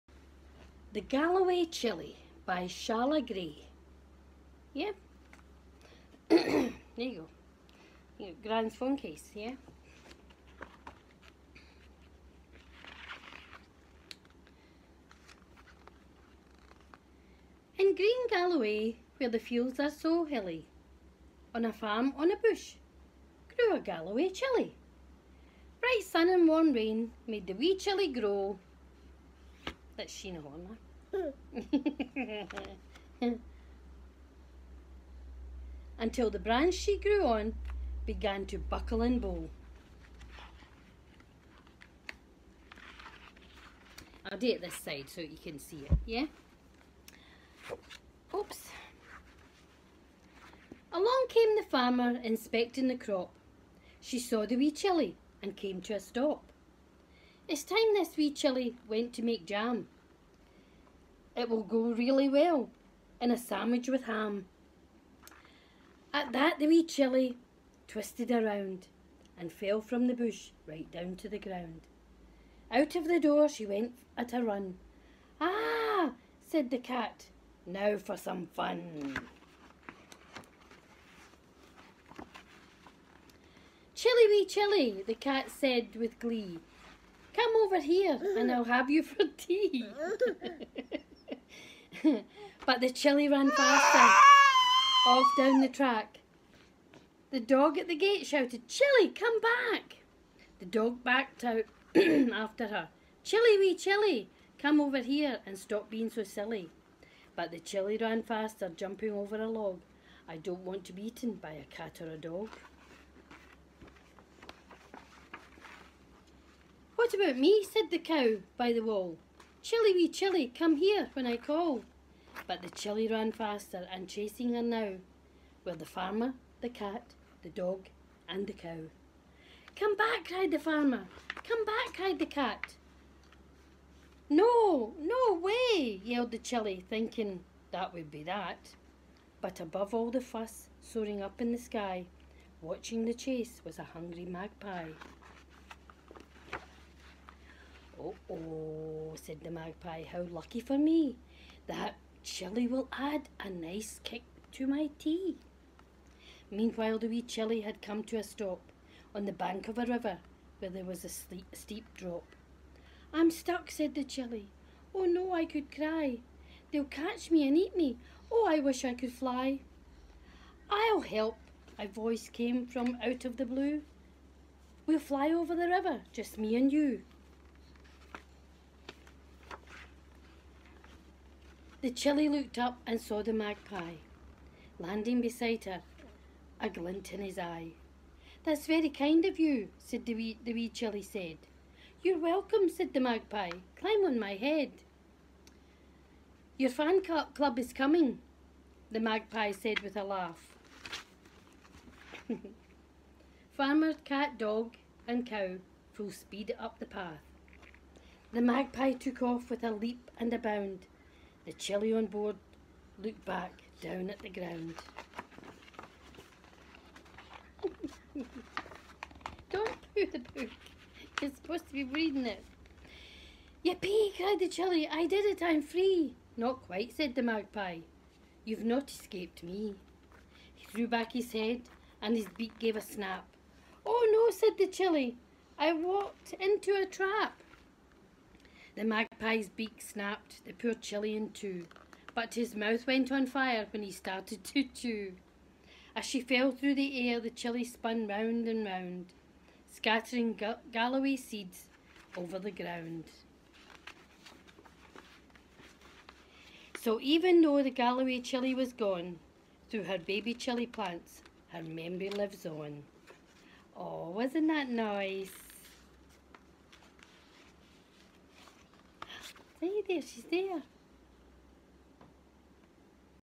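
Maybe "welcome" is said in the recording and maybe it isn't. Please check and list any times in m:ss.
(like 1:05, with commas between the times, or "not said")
3:12.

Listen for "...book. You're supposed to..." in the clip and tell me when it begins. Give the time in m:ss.
3:40.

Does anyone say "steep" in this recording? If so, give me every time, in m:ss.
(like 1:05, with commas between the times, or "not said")
2:41.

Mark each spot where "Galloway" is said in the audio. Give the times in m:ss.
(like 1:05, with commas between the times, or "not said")
0:00, 0:18, 0:23, 4:10, 4:17.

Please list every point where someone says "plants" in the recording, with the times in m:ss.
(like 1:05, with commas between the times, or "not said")
4:20.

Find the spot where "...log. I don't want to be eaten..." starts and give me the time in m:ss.
1:49.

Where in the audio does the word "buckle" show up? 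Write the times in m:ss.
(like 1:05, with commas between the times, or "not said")
0:38.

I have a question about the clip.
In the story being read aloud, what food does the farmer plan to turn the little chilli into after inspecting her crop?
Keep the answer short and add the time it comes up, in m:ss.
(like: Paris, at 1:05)
Jam, at 0:59.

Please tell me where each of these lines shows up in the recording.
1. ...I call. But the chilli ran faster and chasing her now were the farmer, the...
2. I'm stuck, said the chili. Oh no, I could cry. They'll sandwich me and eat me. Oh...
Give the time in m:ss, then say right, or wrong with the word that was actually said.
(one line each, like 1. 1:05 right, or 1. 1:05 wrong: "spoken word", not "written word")
1. 2:01 right
2. 2:43 wrong: "catch", not "sandwich".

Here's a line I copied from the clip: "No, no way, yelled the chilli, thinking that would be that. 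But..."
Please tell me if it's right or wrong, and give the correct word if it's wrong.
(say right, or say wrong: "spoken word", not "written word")
right.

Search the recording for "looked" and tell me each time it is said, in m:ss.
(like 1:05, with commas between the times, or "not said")
3:02, 3:33.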